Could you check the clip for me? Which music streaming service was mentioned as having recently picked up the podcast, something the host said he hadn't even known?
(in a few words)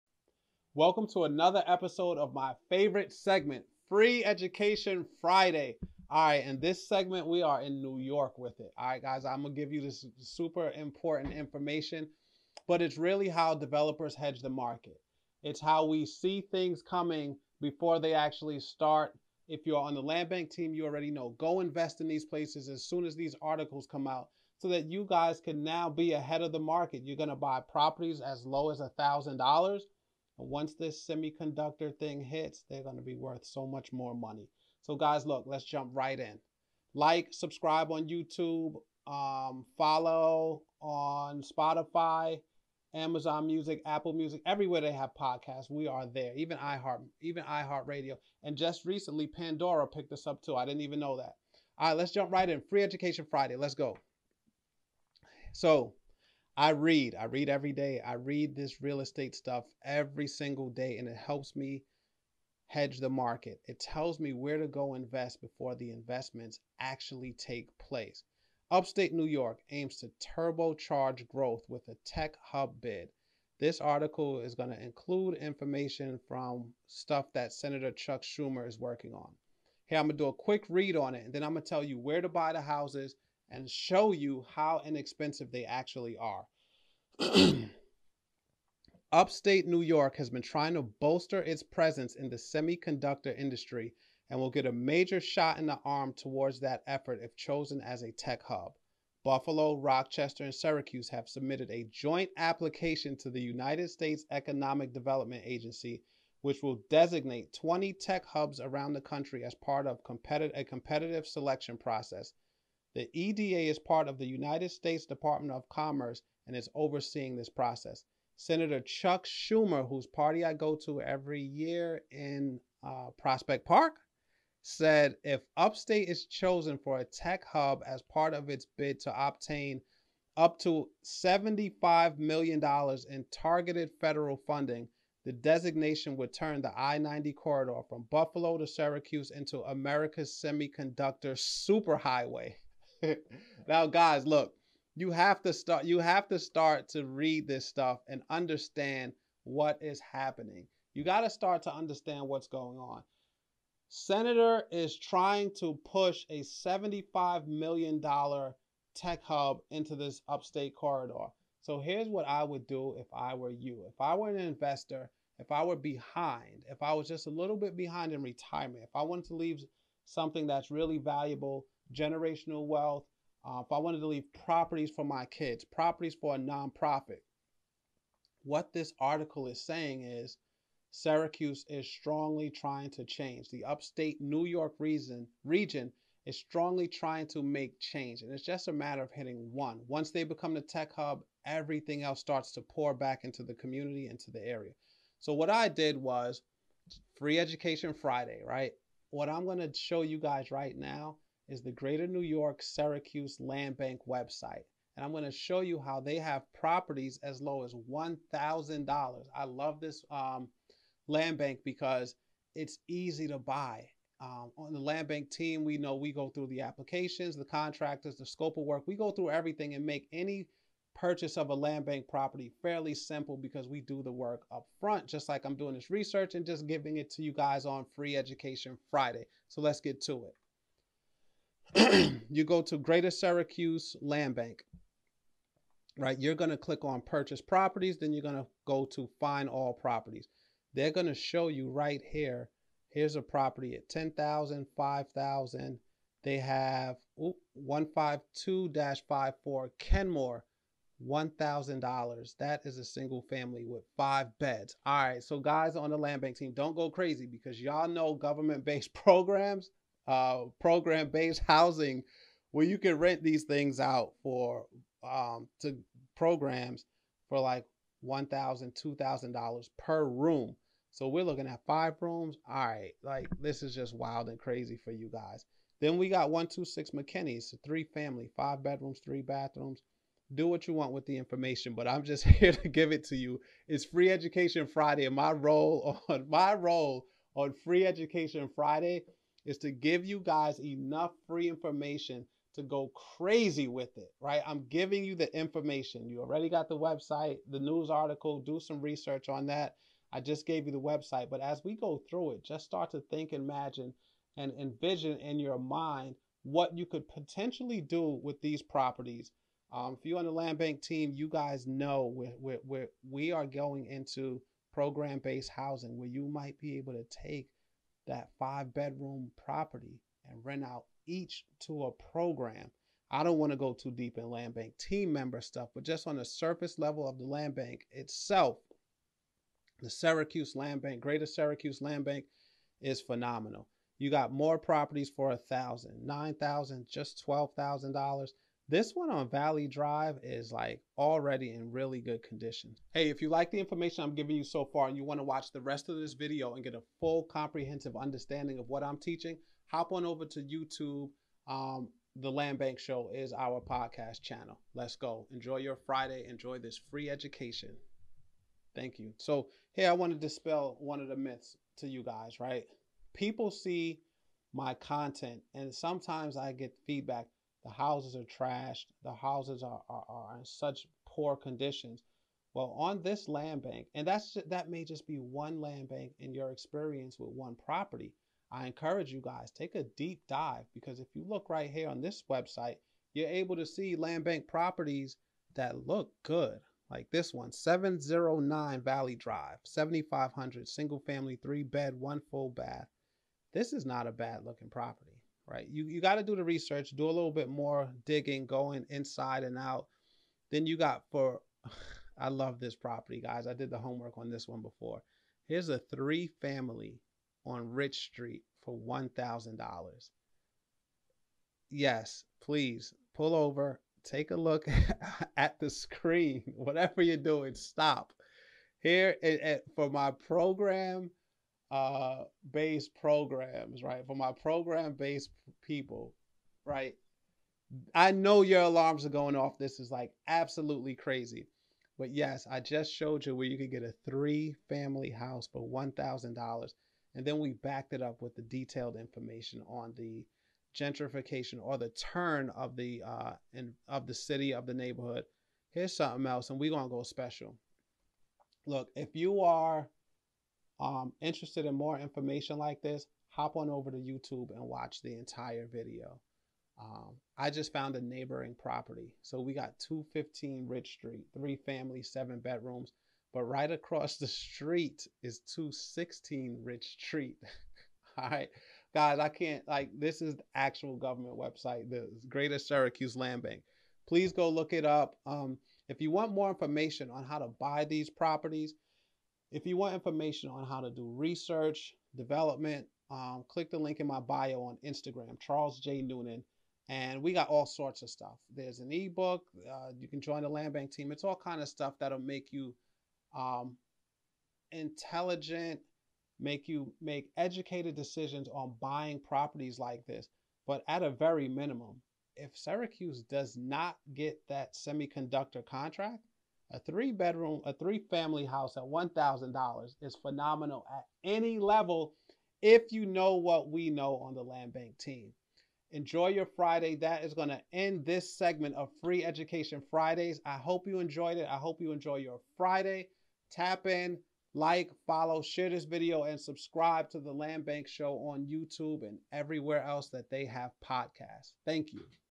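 Pandora.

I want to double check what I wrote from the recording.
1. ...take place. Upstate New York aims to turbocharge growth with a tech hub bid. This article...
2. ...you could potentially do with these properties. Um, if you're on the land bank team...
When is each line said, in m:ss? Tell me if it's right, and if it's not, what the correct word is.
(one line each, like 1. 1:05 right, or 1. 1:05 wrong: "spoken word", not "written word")
1. 1:07 right
2. 5:06 right.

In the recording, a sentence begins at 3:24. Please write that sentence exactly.
And I'm going to show you how they have properties as low as $1,000.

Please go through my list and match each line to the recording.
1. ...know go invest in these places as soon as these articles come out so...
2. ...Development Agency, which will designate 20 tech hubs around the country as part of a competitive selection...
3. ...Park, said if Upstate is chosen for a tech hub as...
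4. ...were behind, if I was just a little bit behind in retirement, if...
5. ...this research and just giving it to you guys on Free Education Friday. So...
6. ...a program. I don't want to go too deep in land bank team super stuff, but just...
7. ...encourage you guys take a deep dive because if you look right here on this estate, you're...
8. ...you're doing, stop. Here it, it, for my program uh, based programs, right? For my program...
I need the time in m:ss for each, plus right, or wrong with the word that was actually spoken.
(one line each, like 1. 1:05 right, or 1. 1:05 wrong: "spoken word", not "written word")
1. 0:21 right
2. 1:44 right
3. 2:03 right
4. 2:45 right
5. 3:45 right
6. 5:21 wrong: "member", not "super"
7. 6:18 wrong: "website", not "estate"
8. 6:57 right.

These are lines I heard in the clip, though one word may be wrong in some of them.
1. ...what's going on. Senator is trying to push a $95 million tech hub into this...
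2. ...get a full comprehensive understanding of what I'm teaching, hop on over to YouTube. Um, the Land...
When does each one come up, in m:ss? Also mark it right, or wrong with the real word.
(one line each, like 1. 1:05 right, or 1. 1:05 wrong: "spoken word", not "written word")
1. 2:32 wrong: "75", not "95"
2. 5:46 right.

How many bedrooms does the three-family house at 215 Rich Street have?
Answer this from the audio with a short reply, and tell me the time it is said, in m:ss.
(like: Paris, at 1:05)
7, at 7:42.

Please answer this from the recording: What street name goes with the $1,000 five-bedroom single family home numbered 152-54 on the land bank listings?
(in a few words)
Kenmore.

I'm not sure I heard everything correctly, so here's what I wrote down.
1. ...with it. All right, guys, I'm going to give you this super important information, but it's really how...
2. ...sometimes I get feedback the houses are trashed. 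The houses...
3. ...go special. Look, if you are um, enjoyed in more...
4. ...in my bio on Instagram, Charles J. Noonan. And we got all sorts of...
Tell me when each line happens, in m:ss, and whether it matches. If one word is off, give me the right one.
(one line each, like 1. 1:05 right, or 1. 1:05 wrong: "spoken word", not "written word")
1. 0:08 right
2. 6:05 right
3. 7:26 wrong: "interested", not "enjoyed"
4. 8:03 right.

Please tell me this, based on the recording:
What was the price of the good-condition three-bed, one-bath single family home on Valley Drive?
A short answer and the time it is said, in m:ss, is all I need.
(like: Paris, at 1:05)
$7,500, at 6:29.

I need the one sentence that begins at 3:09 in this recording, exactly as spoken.
Once they become the tech hub, everything else starts to pour back into the community, into the area.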